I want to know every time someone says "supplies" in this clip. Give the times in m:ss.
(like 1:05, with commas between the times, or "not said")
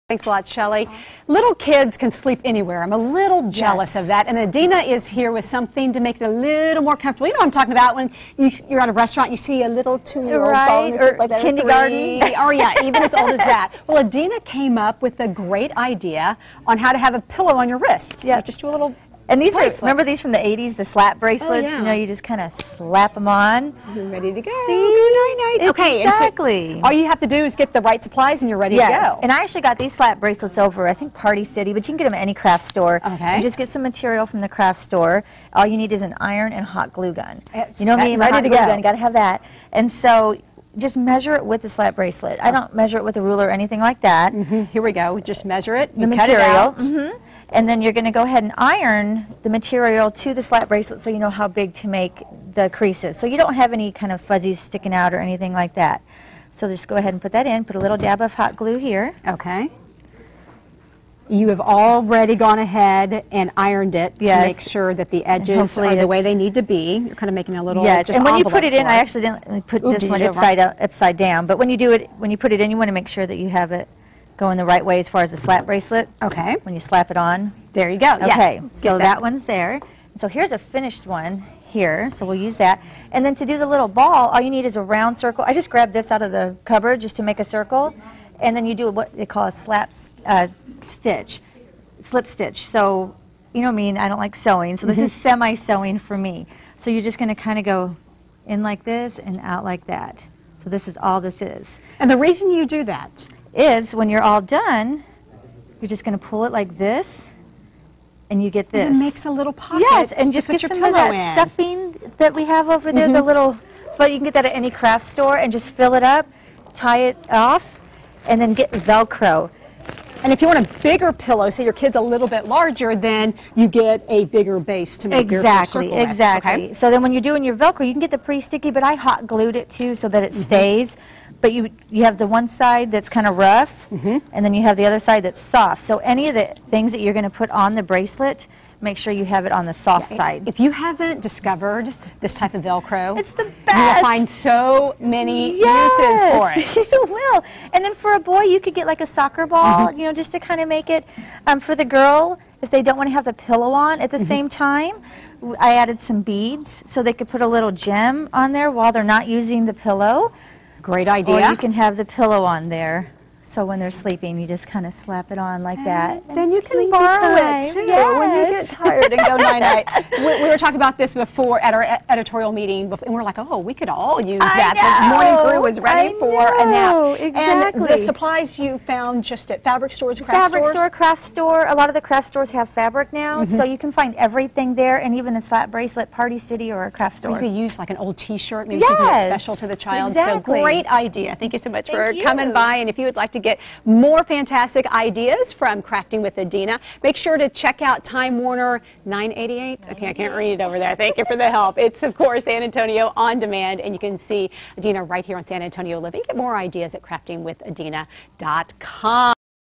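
0:28, 2:58.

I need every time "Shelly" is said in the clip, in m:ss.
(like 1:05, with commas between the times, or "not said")
0:00.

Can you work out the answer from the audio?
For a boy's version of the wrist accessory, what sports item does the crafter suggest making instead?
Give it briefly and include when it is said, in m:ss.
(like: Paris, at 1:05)
Soccer ball, at 2:29.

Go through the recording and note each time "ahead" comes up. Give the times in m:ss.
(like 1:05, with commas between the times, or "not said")
0:48, 0:56, 1:02.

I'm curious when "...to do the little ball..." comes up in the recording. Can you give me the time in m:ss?
1:23.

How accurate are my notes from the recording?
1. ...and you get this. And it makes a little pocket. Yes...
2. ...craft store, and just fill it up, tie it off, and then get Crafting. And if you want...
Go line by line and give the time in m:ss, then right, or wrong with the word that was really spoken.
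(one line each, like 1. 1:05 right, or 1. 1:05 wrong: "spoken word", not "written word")
1. 1:48 right
2. 1:54 wrong: "Velcro", not "Crafting".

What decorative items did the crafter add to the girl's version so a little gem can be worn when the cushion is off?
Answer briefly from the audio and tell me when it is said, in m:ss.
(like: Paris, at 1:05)
Beads, at 2:36.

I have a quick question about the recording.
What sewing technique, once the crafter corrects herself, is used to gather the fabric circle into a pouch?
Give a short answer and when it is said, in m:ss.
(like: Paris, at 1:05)
Slip stitch, at 1:32.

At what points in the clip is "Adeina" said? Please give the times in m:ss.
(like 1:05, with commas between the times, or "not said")
0:04, 0:14, 3:16, 3:24.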